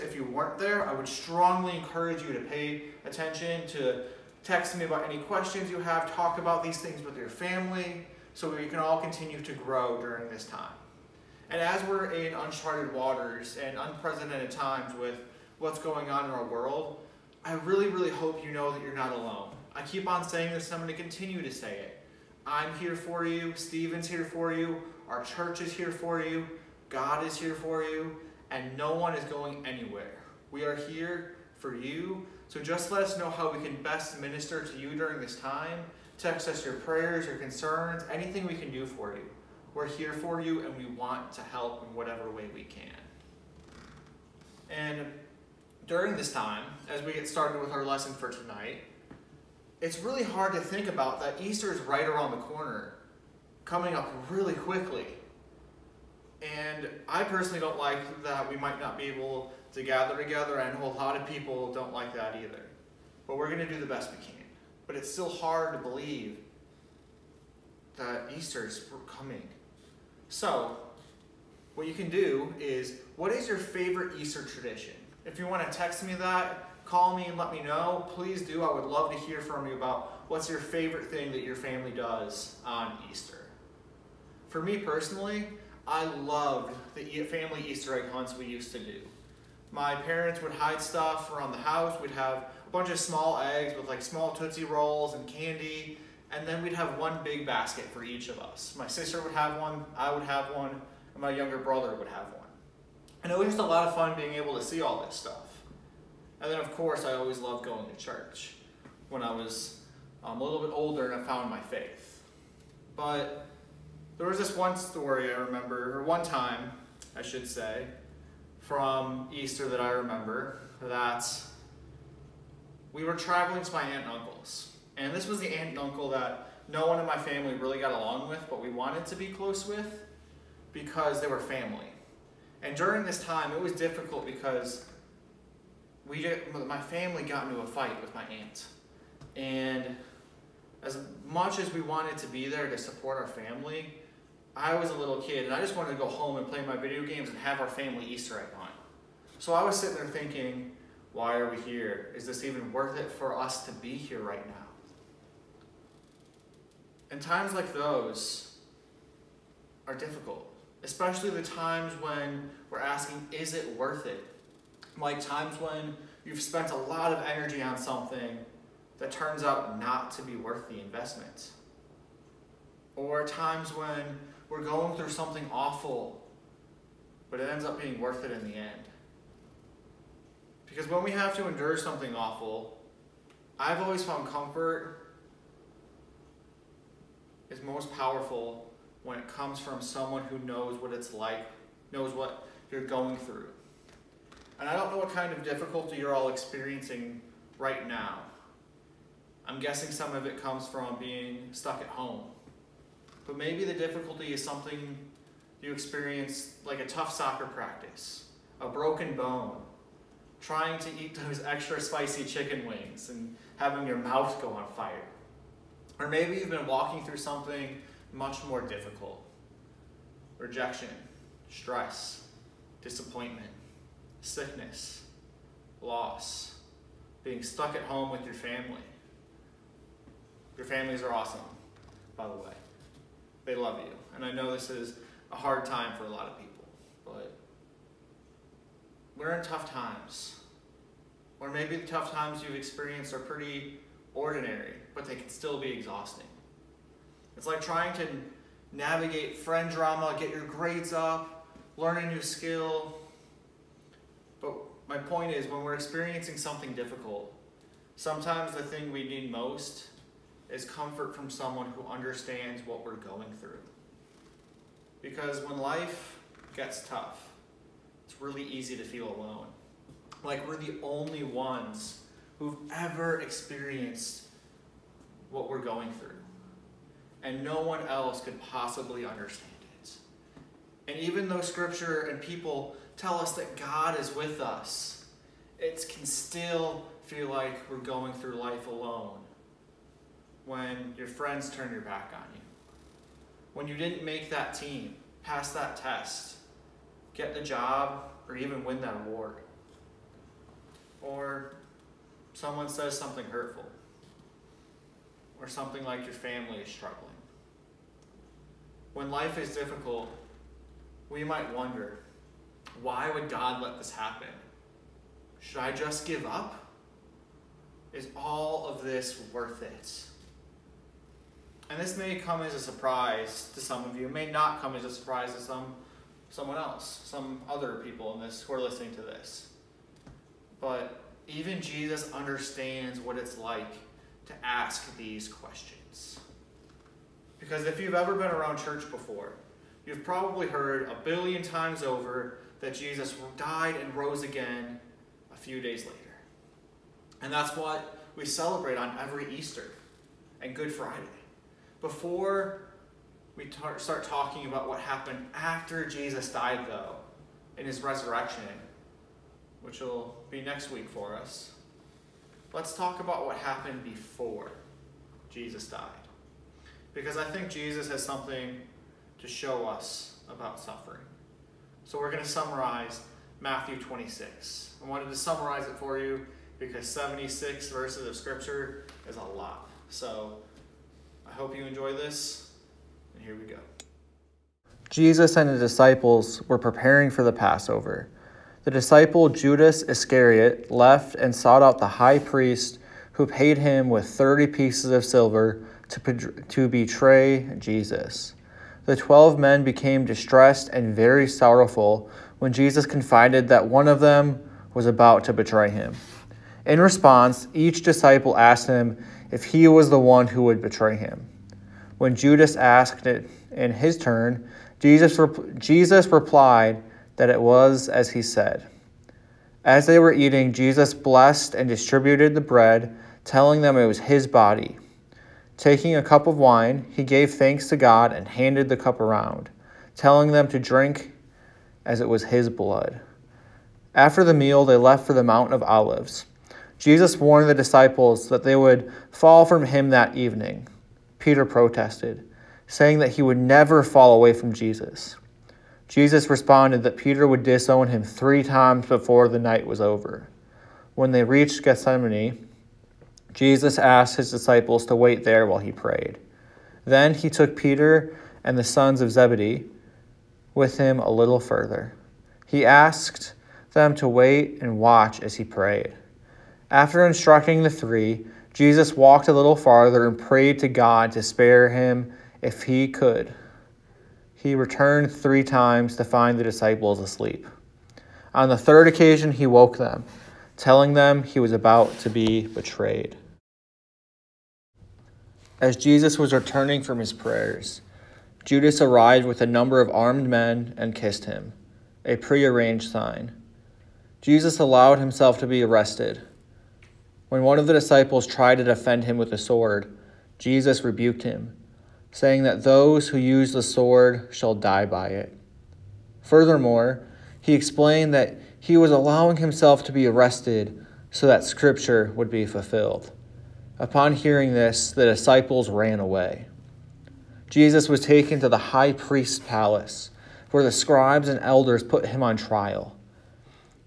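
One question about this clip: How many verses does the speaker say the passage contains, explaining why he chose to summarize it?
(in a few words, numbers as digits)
76.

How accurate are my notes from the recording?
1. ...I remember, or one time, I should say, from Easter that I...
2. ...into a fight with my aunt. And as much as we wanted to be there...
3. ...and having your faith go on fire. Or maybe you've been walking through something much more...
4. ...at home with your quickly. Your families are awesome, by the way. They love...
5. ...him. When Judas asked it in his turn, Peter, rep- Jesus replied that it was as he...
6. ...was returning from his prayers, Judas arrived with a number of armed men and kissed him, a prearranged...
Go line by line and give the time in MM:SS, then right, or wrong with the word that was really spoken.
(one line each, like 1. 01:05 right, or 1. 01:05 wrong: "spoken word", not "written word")
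1. 01:55 right
2. 02:17 right
3. 03:33 wrong: "mouth", not "faith"
4. 03:47 wrong: "family", not "quickly"
5. 06:50 wrong: "Jesus", not "Peter"
6. 08:06 right.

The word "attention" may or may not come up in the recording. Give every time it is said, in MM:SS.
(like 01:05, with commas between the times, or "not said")
00:03.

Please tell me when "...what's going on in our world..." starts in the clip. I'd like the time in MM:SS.
00:15.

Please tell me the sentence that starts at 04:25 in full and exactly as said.
Because when life gets tough, it's really easy to feel alone.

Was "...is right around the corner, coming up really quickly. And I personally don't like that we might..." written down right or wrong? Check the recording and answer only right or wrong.
right.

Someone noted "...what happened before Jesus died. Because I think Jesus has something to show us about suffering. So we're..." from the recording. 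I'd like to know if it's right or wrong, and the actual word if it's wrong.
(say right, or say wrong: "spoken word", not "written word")
right.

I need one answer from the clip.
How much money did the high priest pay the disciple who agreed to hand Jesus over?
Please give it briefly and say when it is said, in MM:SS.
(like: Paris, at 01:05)
30 pieces of silver, at 06:34.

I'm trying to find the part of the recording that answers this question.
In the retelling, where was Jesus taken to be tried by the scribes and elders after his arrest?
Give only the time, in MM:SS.
08:38.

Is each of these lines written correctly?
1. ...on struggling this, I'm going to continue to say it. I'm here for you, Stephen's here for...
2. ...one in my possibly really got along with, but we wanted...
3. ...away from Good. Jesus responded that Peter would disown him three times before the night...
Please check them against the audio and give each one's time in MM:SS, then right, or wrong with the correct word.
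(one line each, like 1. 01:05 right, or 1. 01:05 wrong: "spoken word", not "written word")
1. 00:20 wrong: "saying", not "struggling"
2. 02:06 wrong: "family", not "possibly"
3. 07:24 wrong: "Jesus", not "Good".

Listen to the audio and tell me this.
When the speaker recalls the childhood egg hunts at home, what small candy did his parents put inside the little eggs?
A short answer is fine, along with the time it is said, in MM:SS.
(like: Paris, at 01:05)
Tootsie Rolls, at 01:34.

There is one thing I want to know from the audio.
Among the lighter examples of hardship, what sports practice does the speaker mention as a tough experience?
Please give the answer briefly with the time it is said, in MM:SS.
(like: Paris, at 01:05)
Soccer, at 03:27.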